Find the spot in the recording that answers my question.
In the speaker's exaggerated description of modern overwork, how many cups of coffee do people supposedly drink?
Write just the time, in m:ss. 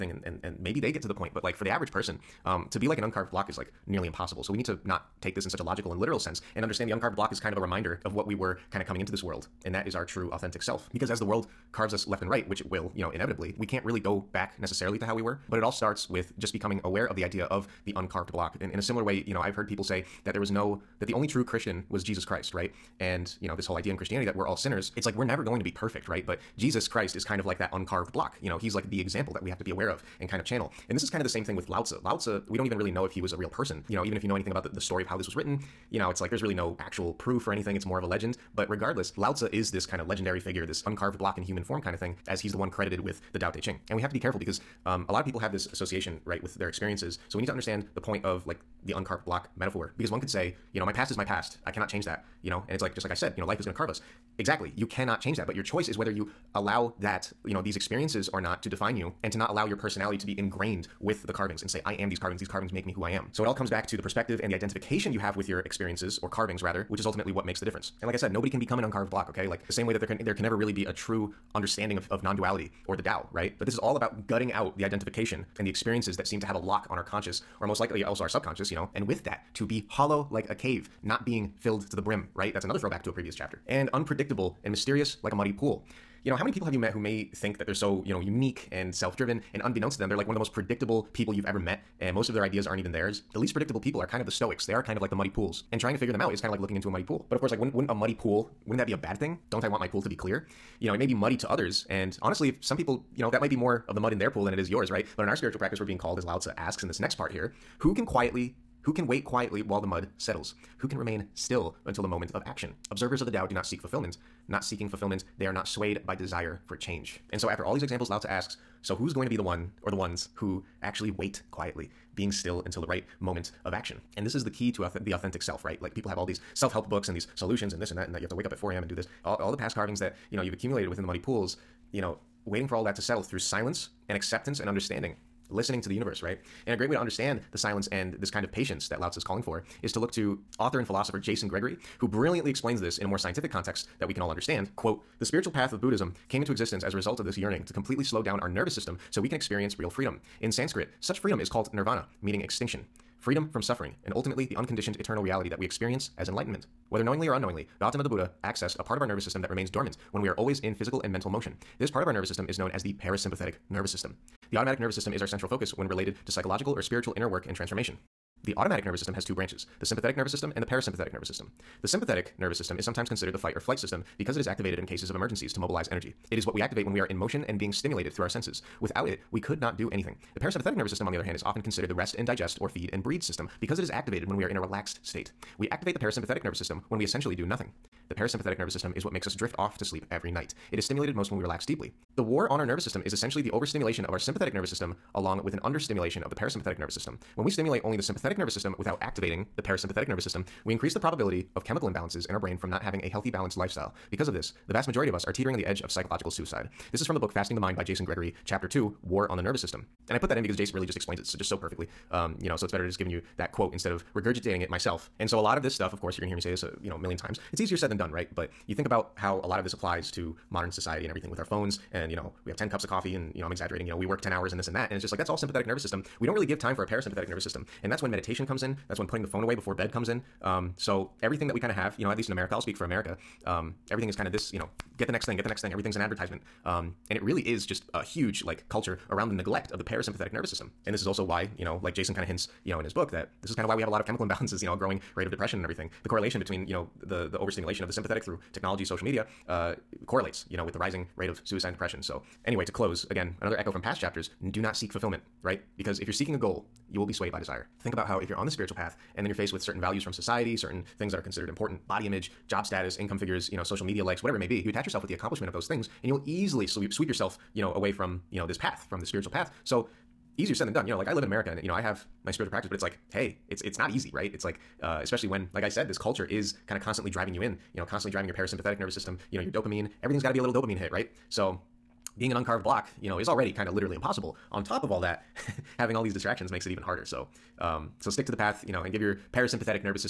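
3:42.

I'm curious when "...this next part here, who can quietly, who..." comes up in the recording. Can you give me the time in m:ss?
1:46.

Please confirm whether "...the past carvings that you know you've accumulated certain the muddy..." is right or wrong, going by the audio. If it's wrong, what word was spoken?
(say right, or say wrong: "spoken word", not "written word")
wrong: "within", not "certain".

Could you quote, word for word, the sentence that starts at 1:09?
Like the same way that there can there can never really be a true understanding of, of non-duality or the Tao, right?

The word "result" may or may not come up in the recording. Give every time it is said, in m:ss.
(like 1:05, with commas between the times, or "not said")
2:26.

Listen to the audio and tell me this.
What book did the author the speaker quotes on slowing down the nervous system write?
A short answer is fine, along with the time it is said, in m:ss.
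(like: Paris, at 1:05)
Fasting the Mind, at 3:27.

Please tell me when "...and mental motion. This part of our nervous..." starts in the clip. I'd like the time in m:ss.
2:41.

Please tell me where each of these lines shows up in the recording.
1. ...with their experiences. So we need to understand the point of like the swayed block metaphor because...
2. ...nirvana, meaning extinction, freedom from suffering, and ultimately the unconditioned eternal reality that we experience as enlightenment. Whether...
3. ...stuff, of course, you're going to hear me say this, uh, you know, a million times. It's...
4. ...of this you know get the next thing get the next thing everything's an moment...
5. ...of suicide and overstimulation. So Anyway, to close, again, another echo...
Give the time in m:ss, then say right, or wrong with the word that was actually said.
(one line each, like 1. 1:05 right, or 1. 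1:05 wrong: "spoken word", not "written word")
1. 0:46 wrong: "uncarved", not "swayed"
2. 2:31 right
3. 3:35 right
4. 3:54 wrong: "advertisement", not "moment"
5. 4:11 wrong: "depression", not "overstimulation".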